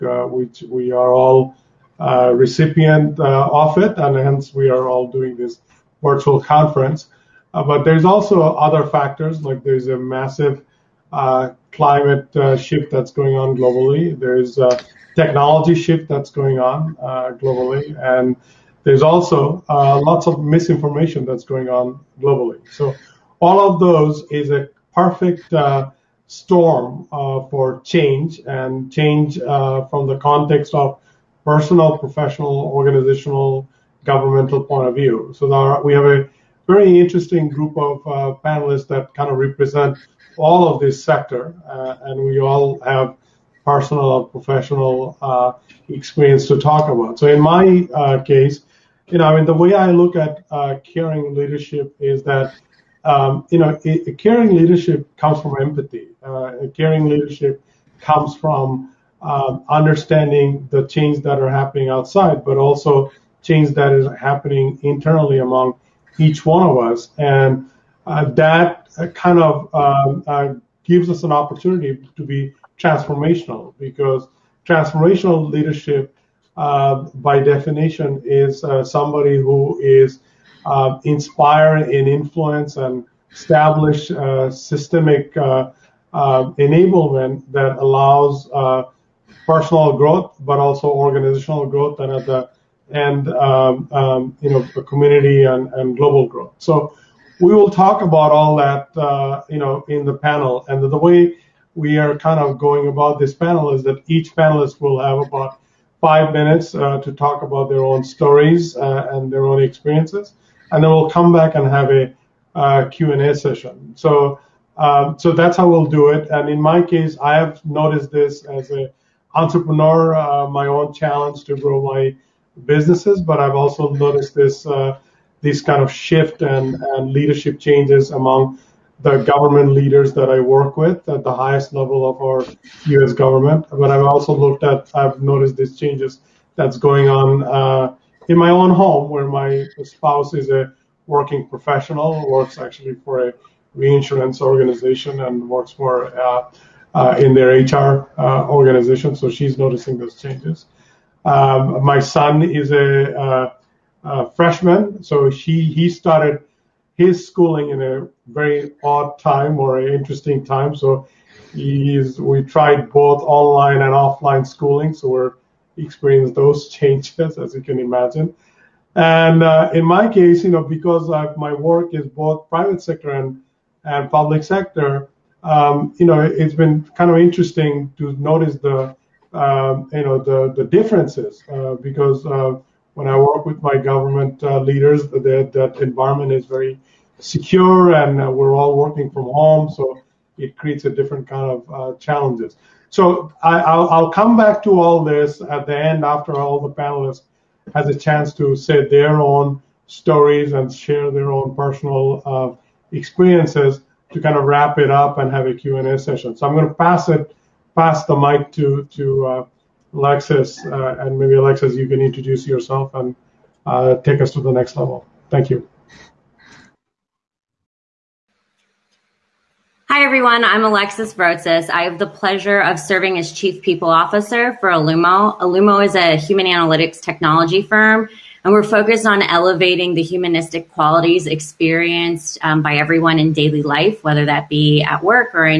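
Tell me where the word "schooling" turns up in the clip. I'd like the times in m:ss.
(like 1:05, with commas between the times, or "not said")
2:37, 2:44.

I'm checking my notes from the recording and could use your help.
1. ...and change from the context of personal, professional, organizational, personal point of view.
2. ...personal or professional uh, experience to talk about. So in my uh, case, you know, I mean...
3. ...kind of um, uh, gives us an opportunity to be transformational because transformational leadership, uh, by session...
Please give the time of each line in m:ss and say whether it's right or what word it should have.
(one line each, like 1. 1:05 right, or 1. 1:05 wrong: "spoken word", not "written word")
1. 0:28 wrong: "governmental", not "personal"
2. 0:43 right
3. 1:09 wrong: "definition", not "session".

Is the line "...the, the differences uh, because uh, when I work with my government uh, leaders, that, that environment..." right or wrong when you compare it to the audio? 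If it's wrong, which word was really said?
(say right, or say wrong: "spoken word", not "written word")
right.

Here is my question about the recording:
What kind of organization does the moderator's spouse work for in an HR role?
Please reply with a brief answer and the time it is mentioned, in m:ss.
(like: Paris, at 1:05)
A reinsurance organization, at 2:23.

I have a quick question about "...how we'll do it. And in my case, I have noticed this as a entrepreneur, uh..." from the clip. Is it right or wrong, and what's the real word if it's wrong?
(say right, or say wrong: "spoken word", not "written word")
right.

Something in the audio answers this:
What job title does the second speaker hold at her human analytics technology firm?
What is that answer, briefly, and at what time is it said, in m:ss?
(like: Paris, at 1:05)
Chief People Officer, at 3:43.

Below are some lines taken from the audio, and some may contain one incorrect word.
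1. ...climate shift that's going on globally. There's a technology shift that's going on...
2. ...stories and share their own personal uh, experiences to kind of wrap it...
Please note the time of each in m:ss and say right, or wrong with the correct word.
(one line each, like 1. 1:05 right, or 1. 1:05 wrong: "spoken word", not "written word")
1. 0:11 right
2. 3:19 right.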